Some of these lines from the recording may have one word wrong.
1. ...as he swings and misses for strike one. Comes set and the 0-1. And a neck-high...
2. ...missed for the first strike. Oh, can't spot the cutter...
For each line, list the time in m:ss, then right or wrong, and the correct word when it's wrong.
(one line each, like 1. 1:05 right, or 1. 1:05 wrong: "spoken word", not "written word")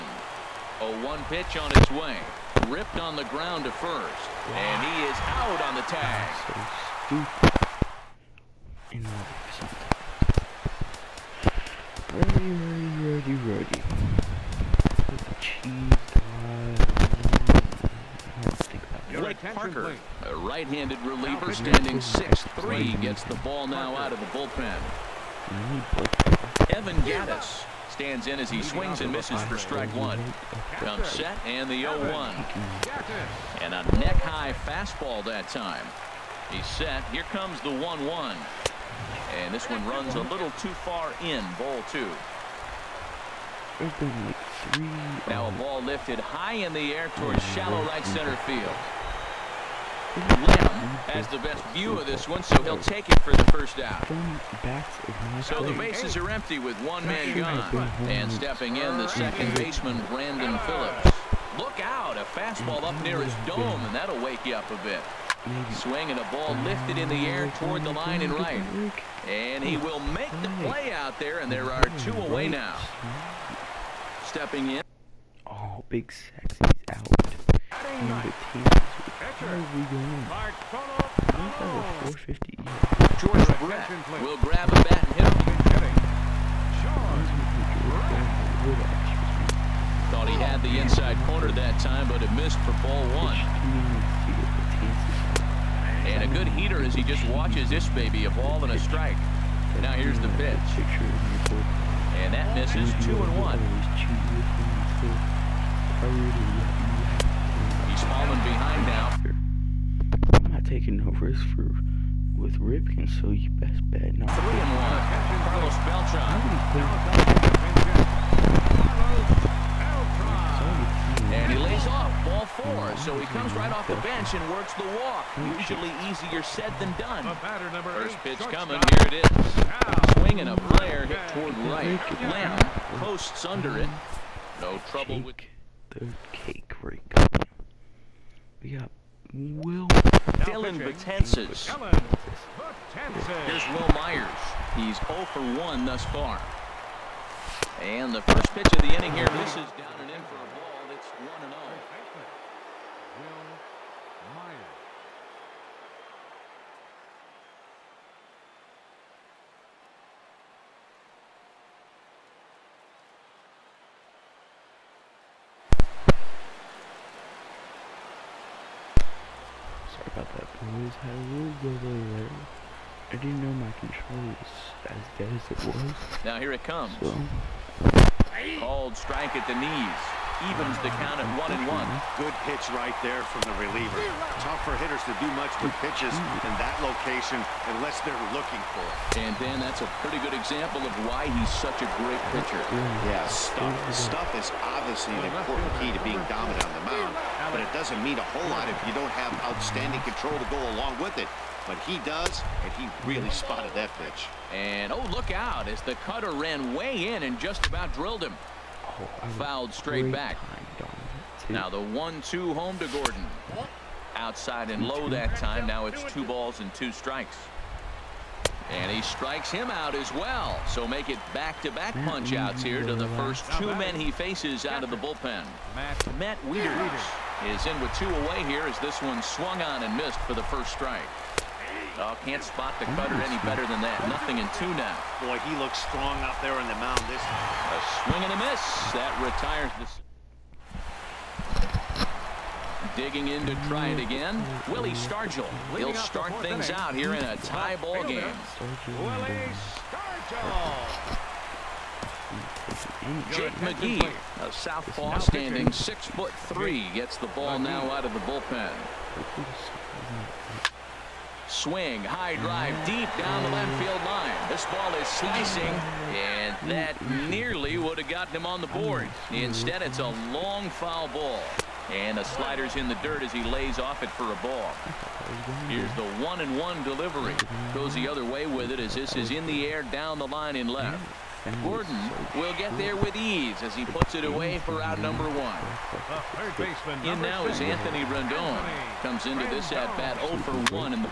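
1. 0:28 right
2. 3:49 right.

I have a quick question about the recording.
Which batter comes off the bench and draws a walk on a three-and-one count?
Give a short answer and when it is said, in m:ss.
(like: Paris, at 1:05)
Carlos Beltran, at 1:55.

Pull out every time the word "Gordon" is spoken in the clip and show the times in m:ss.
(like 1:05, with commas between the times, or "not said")
3:32, 4:41.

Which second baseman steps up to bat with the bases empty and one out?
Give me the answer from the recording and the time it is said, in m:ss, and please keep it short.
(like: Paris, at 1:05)
Brandon Phillips, at 1:00.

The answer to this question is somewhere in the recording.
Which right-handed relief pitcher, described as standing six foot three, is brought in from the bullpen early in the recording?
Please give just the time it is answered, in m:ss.
0:19.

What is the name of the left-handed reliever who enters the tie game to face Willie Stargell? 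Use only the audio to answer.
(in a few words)
Jake McGee.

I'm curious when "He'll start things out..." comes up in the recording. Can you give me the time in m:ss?
4:05.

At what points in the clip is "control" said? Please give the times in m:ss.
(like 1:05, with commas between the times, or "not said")
2:53, 3:20.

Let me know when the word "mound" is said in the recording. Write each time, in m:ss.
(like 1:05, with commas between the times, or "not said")
3:16, 3:56.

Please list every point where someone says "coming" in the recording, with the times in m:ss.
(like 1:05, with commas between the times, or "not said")
2:08, 2:17.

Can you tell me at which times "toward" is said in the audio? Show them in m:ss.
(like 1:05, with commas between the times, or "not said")
0:47, 1:07, 2:11.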